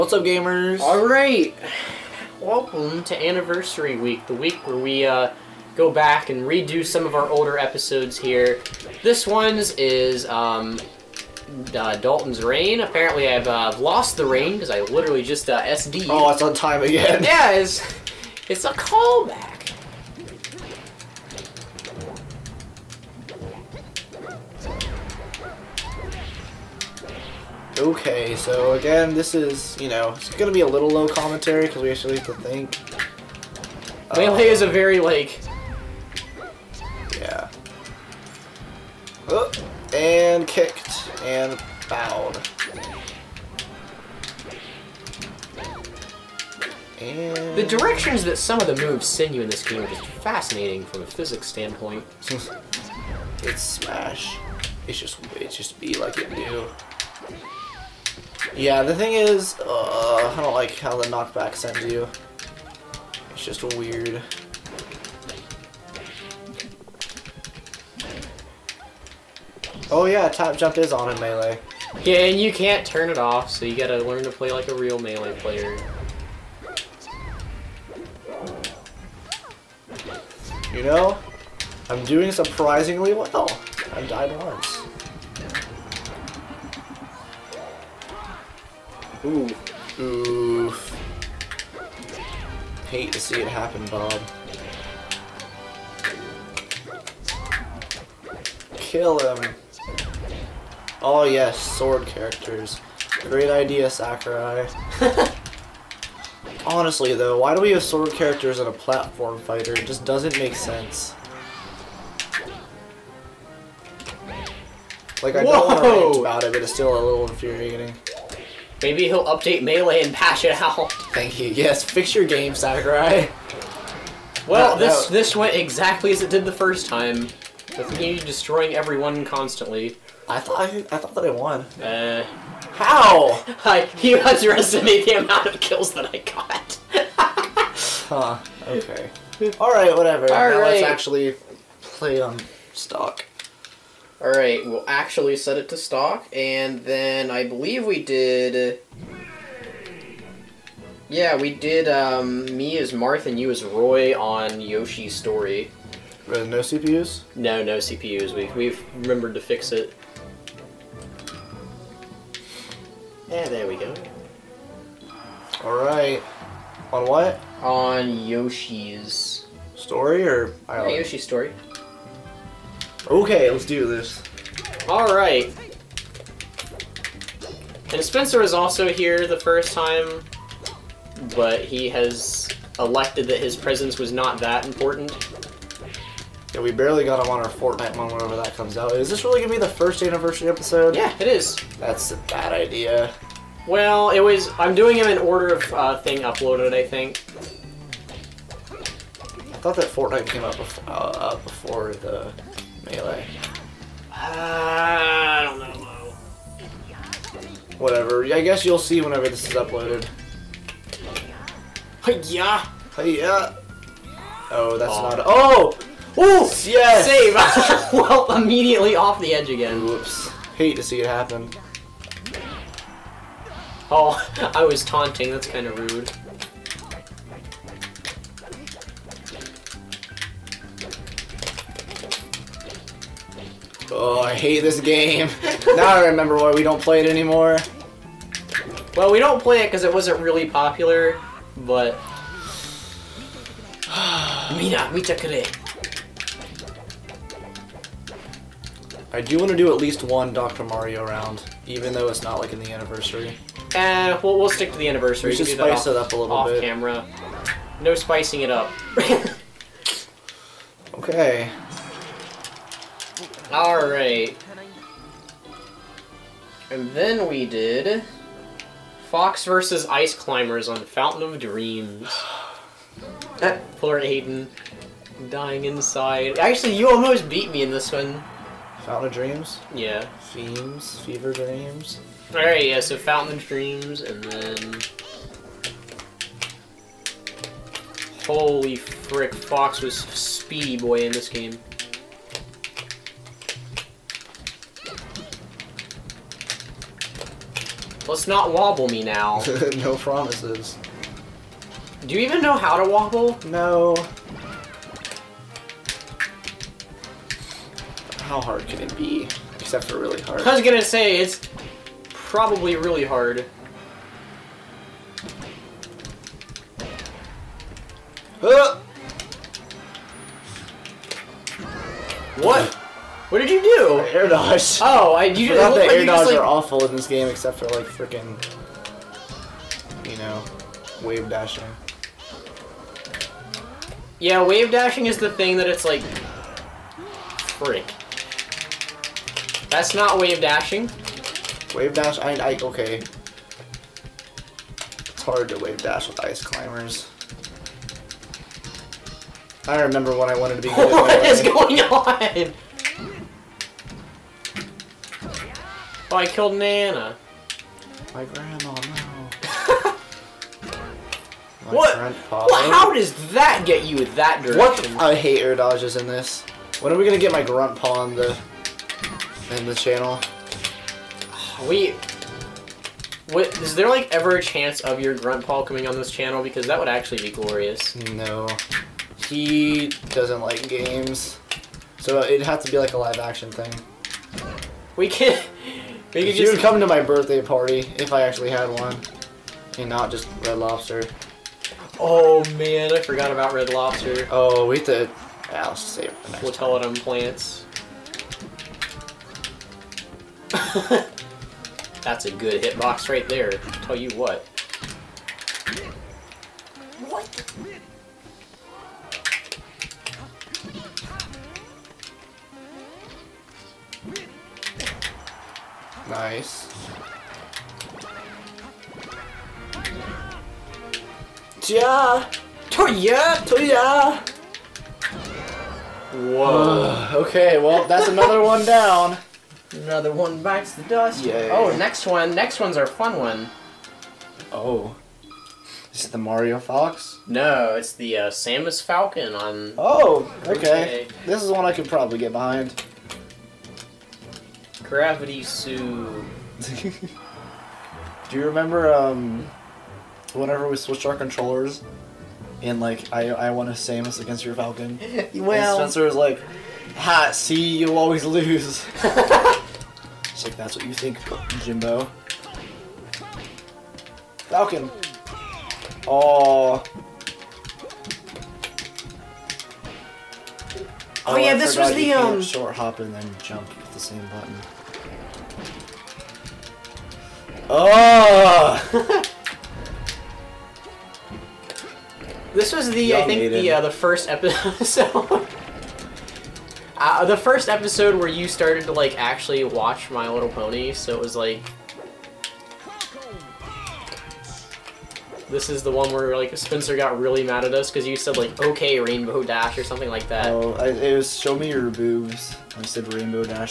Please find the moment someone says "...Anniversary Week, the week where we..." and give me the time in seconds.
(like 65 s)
3 s.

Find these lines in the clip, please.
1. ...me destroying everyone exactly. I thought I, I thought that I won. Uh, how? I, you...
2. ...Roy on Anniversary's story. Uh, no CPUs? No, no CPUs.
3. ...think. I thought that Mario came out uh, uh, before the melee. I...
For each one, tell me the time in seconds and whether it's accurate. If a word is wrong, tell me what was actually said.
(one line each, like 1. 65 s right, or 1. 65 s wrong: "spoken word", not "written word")
1. 128 s wrong: "constantly", not "exactly"
2. 153 s wrong: "Yoshi", not "Anniversary"
3. 196 s wrong: "Fortnite", not "Mario".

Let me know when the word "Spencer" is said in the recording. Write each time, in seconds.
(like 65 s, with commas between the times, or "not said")
178 s, 455 s, 496 s.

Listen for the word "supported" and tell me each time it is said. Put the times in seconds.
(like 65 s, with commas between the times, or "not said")
not said.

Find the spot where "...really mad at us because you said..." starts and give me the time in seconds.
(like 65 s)
497 s.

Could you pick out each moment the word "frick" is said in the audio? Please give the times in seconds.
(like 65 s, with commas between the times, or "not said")
288 s, 337 s.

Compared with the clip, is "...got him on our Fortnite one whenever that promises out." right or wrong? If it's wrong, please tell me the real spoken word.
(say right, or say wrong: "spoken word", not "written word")
wrong: "comes", not "promises".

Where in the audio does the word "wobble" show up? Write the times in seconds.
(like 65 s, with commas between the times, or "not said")
298 s, 302 s.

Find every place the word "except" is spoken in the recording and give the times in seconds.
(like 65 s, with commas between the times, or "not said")
309 s, 327 s.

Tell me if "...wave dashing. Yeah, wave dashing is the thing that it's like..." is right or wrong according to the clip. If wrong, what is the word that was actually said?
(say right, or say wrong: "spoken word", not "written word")
right.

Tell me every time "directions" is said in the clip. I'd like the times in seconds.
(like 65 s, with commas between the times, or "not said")
47 s, 364 s.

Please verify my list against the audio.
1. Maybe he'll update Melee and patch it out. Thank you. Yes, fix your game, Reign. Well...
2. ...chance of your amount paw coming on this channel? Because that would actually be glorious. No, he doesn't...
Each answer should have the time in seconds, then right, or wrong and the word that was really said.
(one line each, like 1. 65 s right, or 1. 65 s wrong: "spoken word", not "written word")
1. 118 s wrong: "Sakurai", not "Reign"
2. 374 s wrong: "grunt", not "amount".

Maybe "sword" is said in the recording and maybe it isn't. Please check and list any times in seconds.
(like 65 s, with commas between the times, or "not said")
101 s, 107 s.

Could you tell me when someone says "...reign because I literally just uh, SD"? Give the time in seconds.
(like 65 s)
14 s.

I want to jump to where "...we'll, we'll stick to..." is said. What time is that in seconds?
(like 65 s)
254 s.